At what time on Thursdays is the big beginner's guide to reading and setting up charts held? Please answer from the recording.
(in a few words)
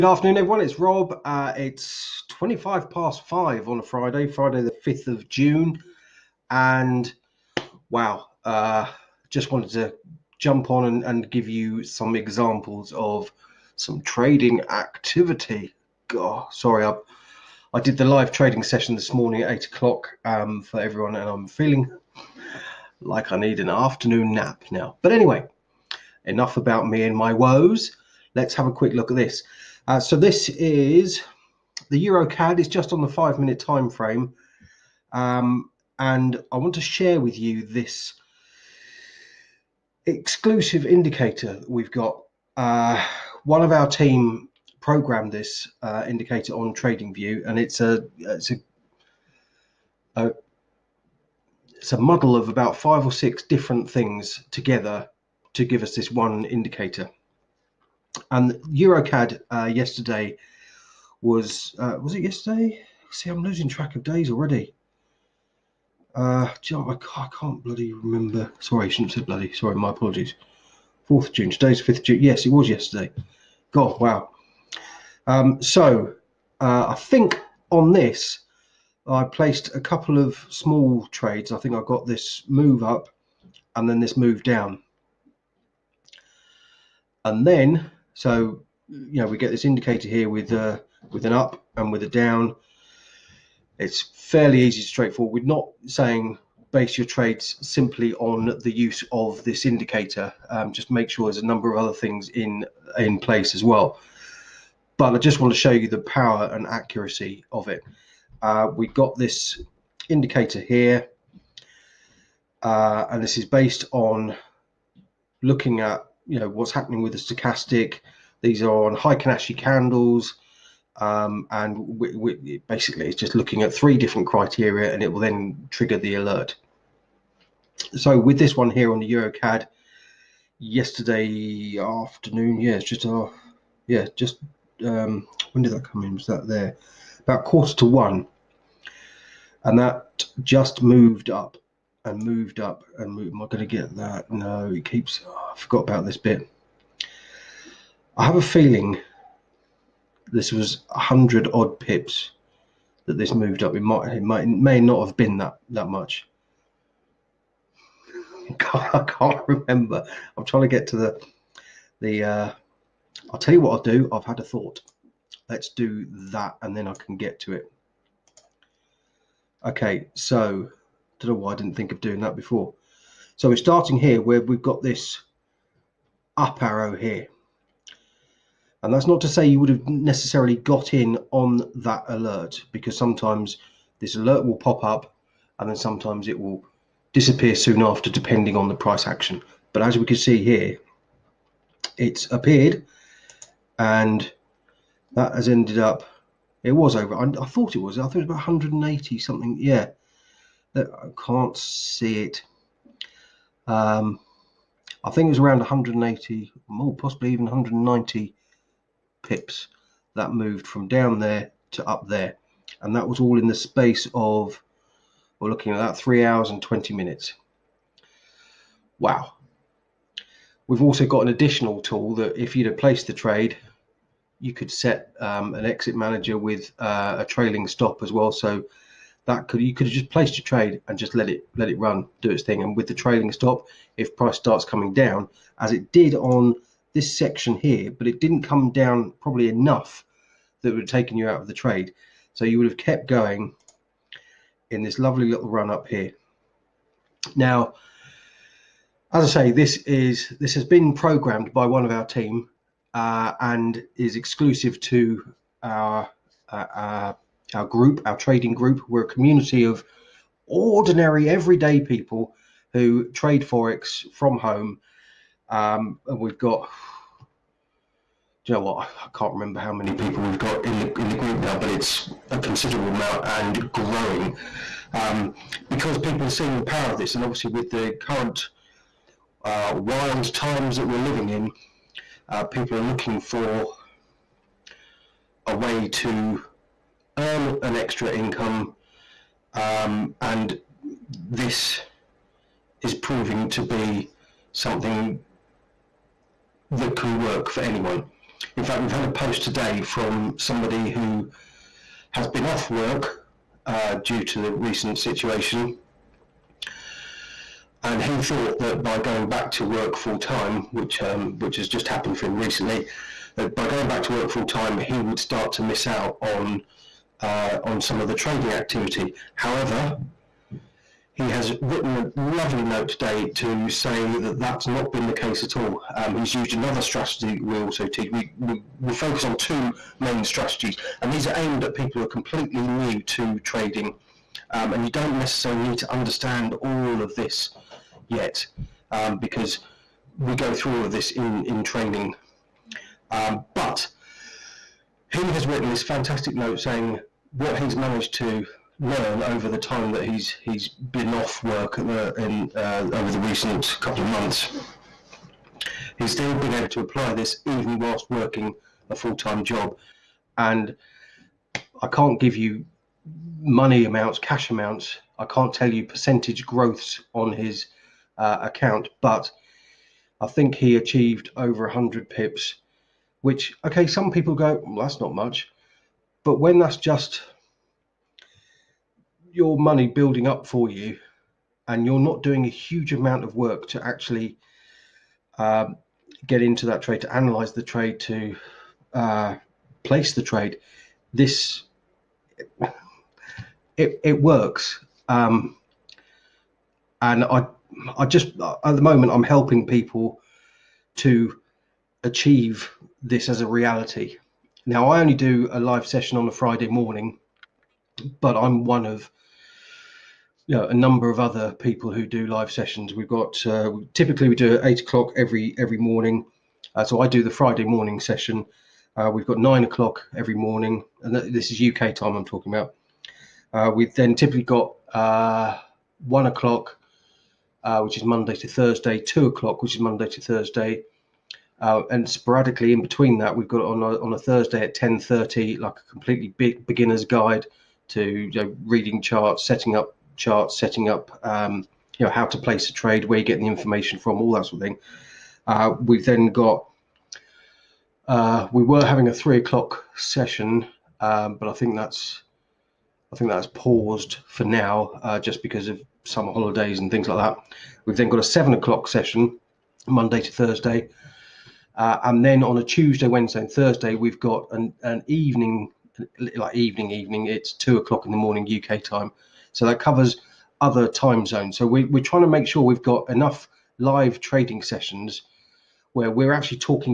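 10.30.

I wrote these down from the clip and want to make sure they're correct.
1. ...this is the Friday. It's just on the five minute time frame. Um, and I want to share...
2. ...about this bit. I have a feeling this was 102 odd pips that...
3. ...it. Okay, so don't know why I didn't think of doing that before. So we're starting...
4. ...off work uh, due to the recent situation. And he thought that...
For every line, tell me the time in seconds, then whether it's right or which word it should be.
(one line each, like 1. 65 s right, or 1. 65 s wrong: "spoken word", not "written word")
1. 30 s wrong: "EuroCAD", not "Friday"
2. 145 s wrong: "100", not "102"
3. 167 s right
4. 302 s right.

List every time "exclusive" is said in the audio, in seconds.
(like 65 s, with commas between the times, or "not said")
40 s, 254 s.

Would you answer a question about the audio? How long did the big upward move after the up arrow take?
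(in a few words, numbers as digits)
3 hours and 20 minutes.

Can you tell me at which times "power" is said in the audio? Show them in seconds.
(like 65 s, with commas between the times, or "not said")
105 s, 276 s.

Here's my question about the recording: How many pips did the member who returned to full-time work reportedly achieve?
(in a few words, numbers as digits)
over 100 pips.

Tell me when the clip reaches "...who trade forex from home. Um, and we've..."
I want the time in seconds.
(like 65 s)
262 s.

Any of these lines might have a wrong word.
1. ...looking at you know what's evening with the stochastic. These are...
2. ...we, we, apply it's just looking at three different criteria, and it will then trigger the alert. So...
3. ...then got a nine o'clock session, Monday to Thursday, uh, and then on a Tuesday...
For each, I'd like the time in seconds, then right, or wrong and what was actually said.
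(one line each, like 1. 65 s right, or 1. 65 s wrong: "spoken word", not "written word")
1. 115 s wrong: "happening", not "evening"
2. 121 s wrong: "basically", not "apply"
3. 457 s wrong: "seven", not "nine".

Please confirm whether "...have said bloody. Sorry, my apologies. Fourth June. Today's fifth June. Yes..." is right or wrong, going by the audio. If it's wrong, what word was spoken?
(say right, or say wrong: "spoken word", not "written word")
right.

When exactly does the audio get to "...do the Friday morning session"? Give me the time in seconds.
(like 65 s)
417 s.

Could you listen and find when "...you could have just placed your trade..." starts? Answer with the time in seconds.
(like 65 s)
229 s.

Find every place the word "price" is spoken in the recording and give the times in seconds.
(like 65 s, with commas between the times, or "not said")
188 s, 234 s.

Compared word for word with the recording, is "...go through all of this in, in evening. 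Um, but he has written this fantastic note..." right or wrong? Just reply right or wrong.
wrong.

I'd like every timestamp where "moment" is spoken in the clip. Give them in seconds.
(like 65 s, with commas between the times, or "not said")
398 s.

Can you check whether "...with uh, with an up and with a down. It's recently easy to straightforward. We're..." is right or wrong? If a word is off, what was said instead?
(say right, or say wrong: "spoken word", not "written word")
wrong: "fairly", not "recently".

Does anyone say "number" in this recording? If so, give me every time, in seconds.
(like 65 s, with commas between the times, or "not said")
101 s, 410 s.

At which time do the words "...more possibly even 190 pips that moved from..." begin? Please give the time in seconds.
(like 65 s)
206 s.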